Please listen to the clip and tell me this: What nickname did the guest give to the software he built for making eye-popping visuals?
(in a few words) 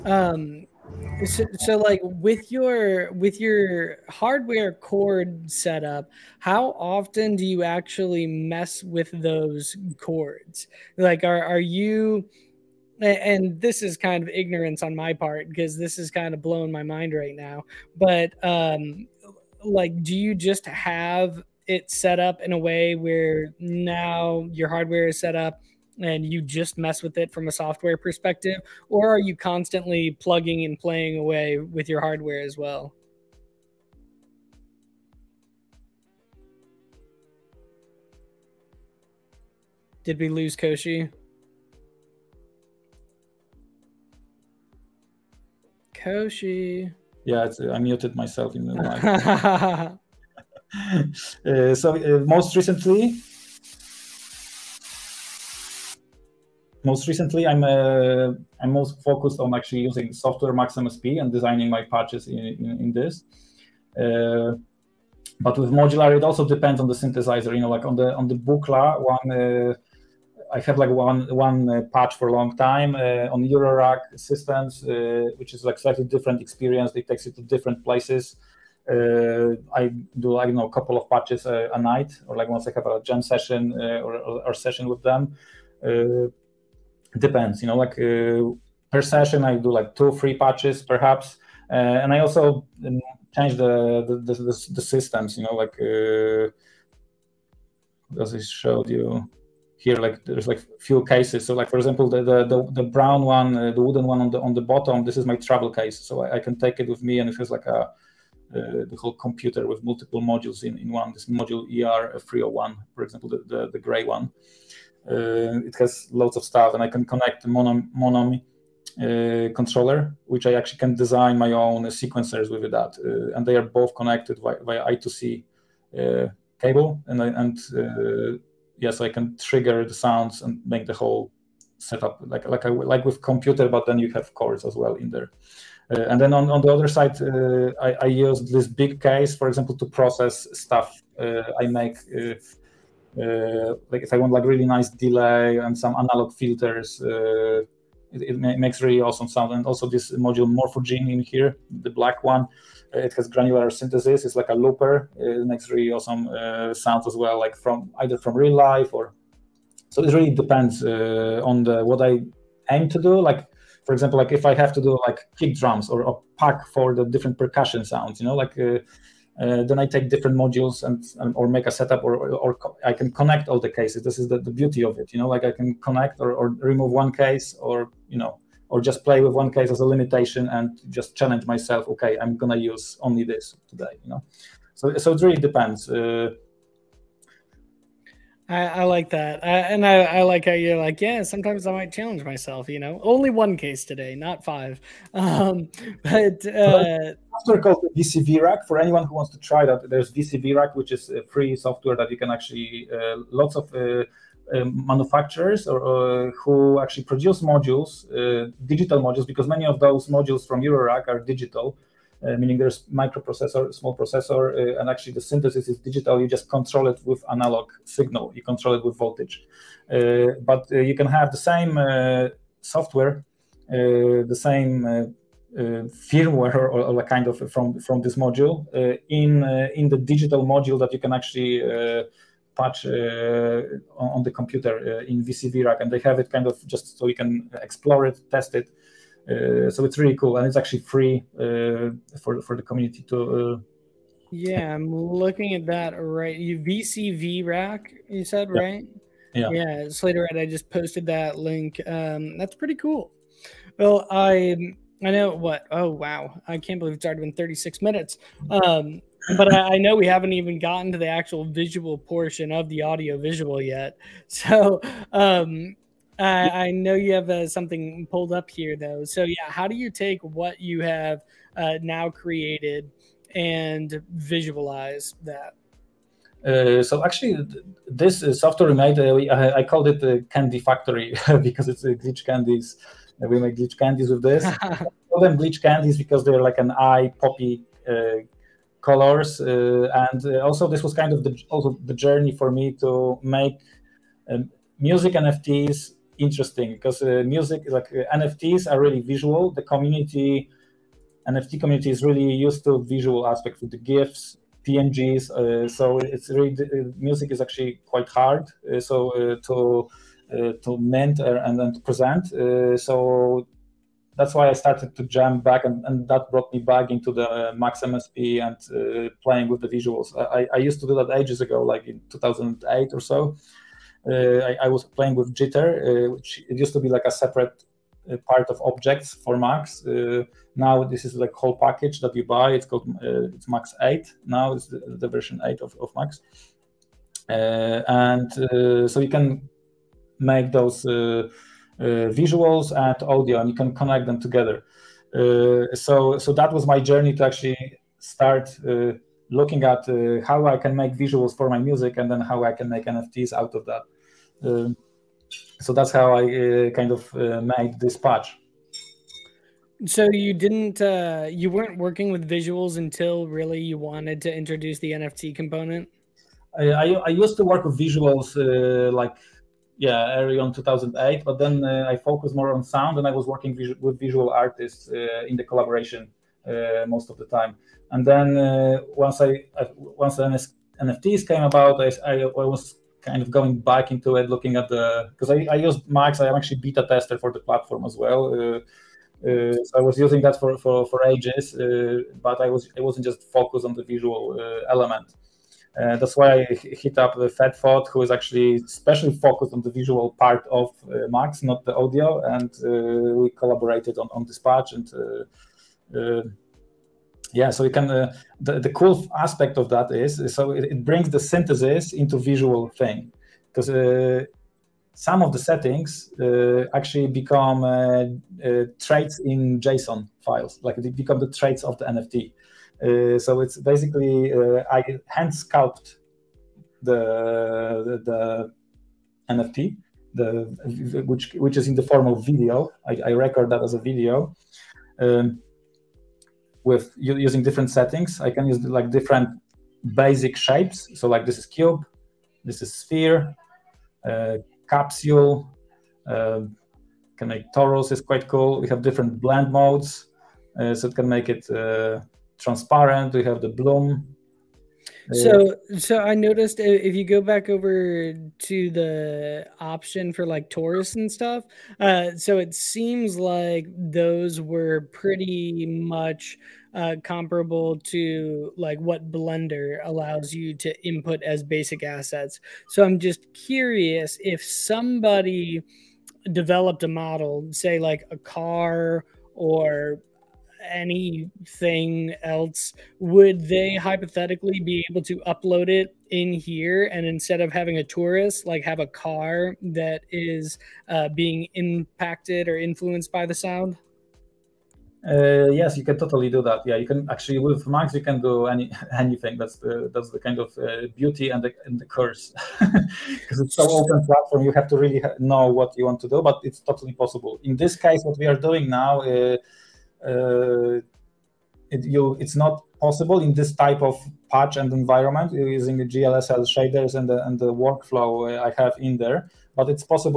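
Candy Factory.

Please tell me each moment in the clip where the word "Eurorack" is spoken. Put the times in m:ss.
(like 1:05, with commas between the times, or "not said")
1:13, 3:30.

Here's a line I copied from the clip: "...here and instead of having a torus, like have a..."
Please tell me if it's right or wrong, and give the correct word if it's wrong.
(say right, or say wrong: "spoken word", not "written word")
right.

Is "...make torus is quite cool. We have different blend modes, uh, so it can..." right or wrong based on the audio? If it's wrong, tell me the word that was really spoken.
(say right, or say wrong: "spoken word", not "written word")
right.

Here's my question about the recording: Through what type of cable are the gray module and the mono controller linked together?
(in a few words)
I2C.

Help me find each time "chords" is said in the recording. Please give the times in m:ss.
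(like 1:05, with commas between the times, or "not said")
0:04, 0:09, 2:14.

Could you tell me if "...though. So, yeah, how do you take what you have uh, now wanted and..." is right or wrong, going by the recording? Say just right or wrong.
wrong.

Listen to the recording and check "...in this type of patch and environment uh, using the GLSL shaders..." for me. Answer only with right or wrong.
right.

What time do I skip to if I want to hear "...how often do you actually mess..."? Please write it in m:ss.
0:06.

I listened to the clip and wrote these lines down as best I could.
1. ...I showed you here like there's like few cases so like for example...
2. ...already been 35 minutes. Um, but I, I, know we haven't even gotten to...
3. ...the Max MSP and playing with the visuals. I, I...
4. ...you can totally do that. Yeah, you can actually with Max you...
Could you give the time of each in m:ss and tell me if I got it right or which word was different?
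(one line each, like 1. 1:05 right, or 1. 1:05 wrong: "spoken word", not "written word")
1. 1:38 right
2. 4:17 wrong: "36", not "35"
3. 5:17 right
4. 8:15 right.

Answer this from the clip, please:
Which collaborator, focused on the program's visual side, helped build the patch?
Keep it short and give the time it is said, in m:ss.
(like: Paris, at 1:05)
FedFod, at 6:37.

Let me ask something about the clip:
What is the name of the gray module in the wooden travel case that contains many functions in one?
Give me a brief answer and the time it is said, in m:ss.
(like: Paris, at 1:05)
ER301, at 1:51.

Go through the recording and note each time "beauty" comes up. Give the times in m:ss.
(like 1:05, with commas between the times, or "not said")
2:54, 8:20.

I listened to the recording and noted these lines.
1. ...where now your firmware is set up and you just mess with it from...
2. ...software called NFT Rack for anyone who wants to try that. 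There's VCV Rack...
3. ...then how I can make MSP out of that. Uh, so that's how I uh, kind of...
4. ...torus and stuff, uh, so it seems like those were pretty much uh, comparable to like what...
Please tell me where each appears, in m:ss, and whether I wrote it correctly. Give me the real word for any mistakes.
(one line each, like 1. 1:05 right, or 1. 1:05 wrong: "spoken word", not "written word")
1. 0:22 wrong: "hardware", not "firmware"
2. 3:17 wrong: "VCV", not "NFT"
3. 5:52 wrong: "NFTs", not "MSP"
4. 7:40 right.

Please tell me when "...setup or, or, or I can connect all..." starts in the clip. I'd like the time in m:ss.
2:51.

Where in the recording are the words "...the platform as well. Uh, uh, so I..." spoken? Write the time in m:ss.
6:27.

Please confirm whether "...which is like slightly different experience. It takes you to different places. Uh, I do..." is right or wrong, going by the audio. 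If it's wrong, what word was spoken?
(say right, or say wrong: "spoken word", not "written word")
right.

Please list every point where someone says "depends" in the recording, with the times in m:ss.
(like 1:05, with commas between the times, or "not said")
1:06, 1:27, 2:40, 3:05.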